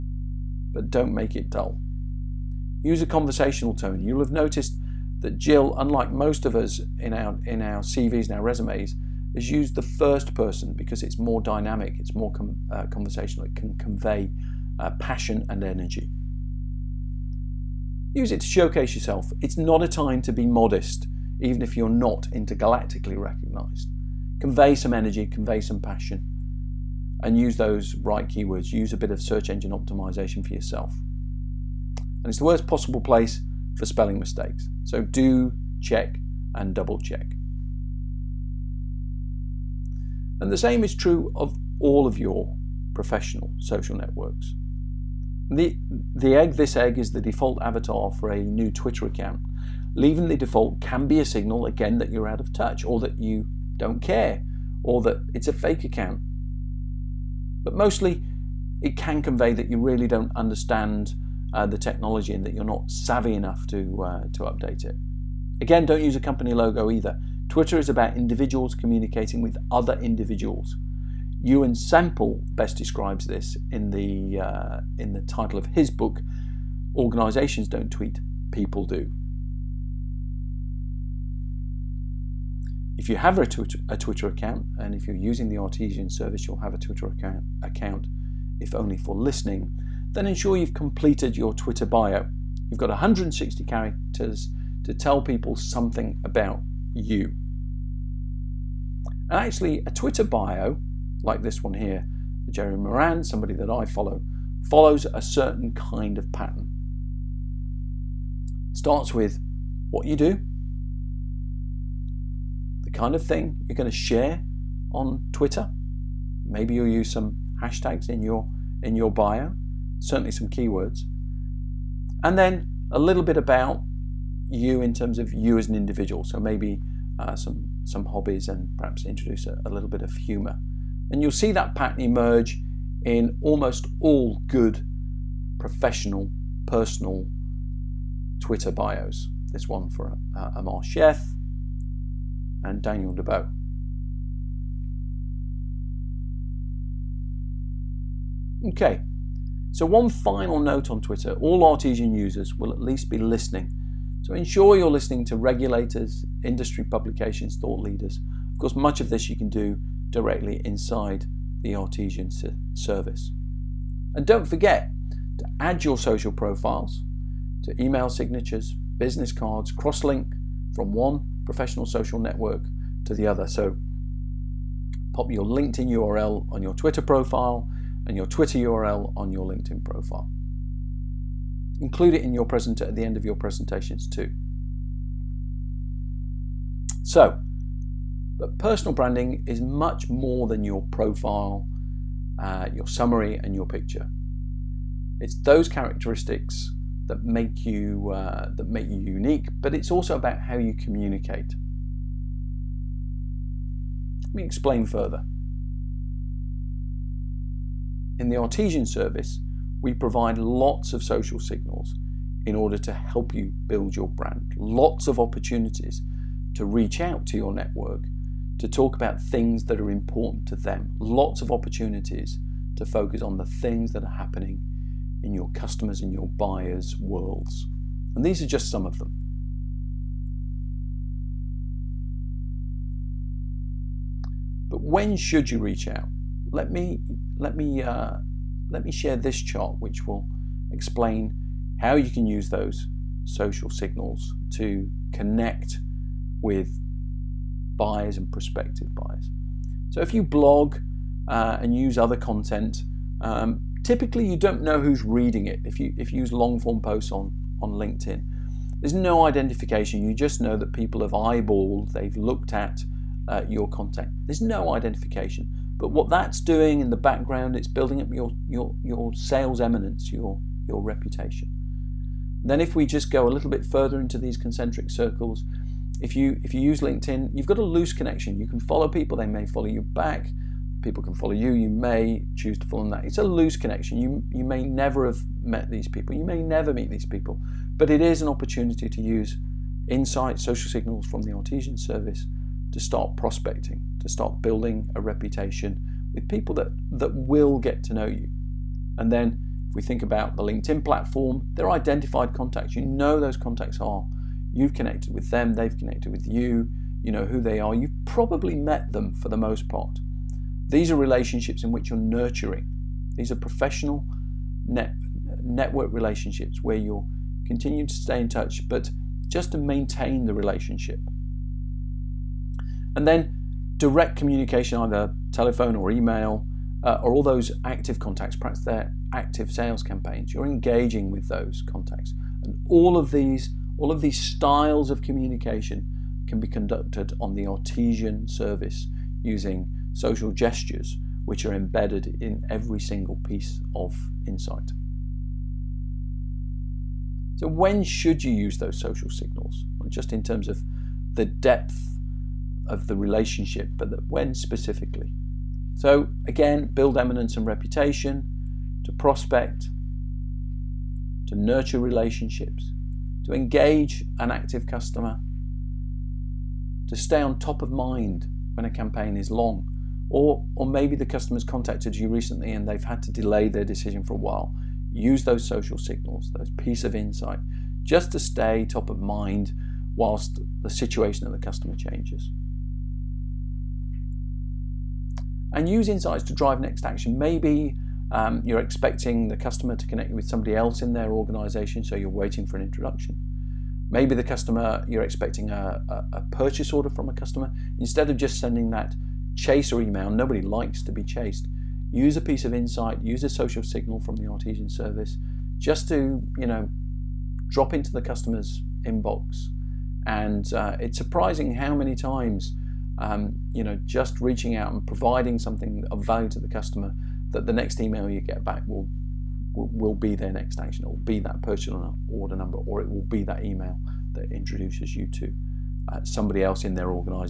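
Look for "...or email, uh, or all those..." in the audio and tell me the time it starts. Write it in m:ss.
5:25.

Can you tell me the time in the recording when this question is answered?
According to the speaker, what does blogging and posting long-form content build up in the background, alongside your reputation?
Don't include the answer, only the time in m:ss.
4:29.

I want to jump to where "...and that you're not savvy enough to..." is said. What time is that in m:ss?
1:02.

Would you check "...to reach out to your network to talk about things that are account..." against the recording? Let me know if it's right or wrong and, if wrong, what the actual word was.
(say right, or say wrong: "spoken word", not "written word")
wrong: "important", not "account".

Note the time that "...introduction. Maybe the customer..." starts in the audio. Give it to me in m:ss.
6:32.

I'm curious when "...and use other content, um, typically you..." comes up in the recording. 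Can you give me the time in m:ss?
4:11.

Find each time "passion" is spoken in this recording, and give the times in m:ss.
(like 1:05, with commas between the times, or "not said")
0:14, 0:25.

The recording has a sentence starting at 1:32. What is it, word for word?
You've got 160 characters to tell people something about you.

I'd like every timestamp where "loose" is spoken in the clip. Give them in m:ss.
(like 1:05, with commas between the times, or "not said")
4:37, 4:43.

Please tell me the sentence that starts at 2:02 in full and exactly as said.
And then a little bit about you in terms of you as an individual.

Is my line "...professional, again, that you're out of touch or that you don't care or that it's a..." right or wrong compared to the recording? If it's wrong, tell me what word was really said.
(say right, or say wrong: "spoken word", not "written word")
wrong: "signal", not "professional".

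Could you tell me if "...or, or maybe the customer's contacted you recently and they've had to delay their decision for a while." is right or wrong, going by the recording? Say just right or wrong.
right.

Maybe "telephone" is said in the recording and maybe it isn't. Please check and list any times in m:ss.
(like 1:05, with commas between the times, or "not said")
5:25.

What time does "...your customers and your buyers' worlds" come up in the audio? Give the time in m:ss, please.
3:45.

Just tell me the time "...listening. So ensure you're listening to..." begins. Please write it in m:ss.
2:33.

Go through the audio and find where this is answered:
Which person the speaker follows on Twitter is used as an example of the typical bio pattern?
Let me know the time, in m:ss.
1:42.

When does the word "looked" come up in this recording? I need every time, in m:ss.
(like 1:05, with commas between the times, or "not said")
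4:22.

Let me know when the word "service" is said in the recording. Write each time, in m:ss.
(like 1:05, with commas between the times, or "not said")
1:26, 2:42, 3:28, 4:51, 5:38, 6:44.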